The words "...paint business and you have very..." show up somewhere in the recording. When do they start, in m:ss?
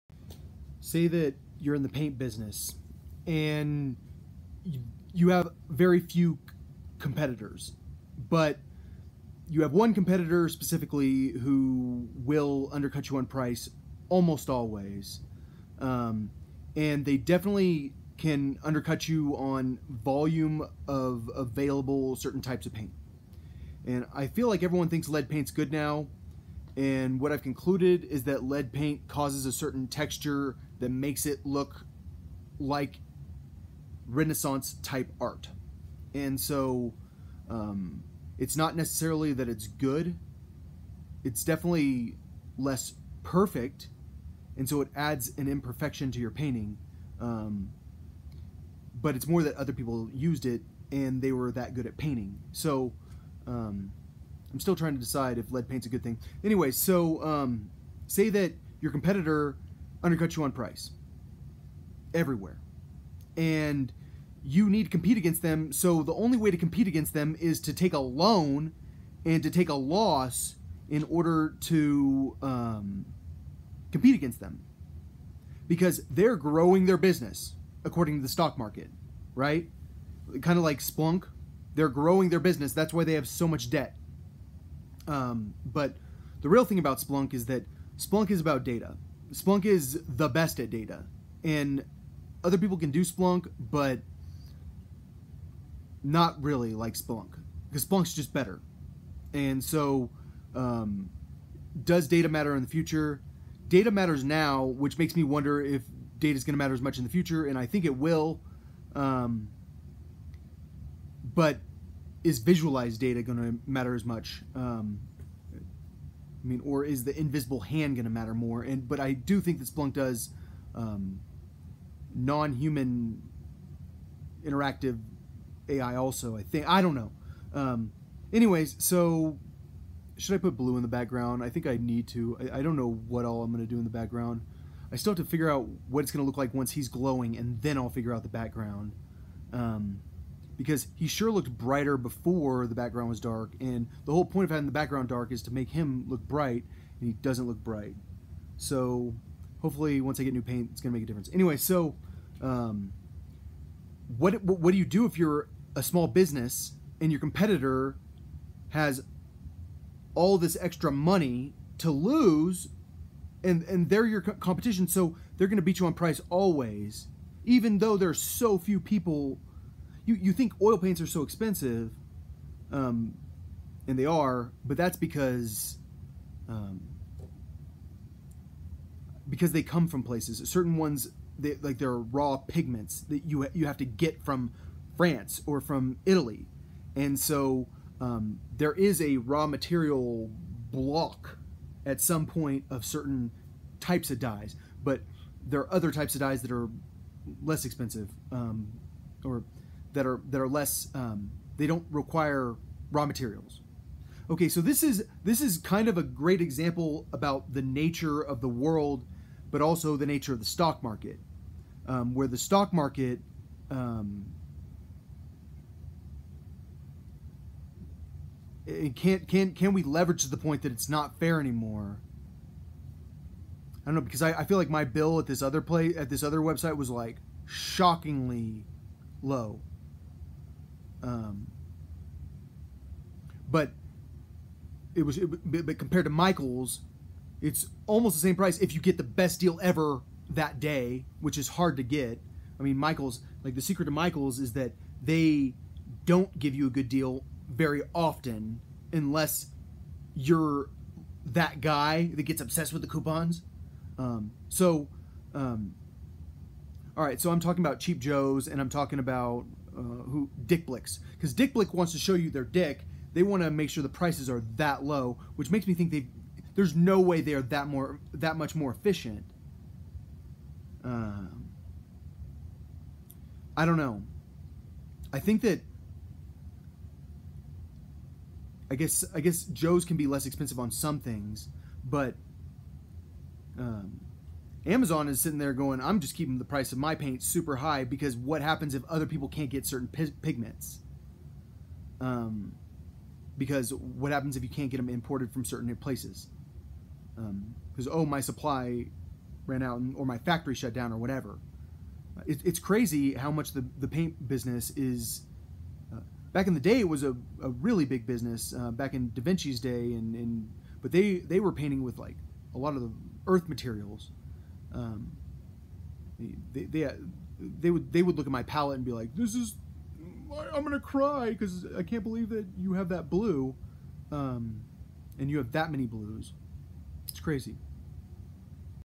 0:01.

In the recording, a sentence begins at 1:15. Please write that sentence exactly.
Because they're growing their business according to the stock market, right?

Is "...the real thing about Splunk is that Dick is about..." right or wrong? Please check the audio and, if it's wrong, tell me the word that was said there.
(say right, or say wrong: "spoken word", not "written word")
wrong: "Splunk", not "Dick".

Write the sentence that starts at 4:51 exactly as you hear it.
Um, because what happens if you can't get them imported from certain places?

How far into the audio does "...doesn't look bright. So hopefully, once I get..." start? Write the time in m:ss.
2:27.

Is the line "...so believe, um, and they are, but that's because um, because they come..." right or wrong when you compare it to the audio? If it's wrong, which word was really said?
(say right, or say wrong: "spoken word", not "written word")
wrong: "expensive", not "believe".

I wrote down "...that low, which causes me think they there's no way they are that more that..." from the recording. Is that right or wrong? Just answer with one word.
wrong.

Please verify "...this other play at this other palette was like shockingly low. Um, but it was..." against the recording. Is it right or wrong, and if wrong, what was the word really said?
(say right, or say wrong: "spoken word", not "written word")
wrong: "website", not "palette".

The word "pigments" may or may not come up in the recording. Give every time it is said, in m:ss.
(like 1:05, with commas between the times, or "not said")
3:02, 4:49.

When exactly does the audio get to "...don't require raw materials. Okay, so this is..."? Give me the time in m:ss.
3:21.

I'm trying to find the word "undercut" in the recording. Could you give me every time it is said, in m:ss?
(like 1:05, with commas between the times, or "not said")
0:12, 0:18, 1:00.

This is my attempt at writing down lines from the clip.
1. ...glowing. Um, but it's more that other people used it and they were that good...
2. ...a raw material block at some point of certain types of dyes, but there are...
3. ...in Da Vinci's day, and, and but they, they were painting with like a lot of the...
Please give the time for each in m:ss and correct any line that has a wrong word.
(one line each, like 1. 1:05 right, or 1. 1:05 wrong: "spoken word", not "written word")
1. 0:46 wrong: "painting", not "glowing"
2. 3:09 right
3. 5:08 right.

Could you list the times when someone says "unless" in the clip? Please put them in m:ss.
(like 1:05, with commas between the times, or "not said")
4:08.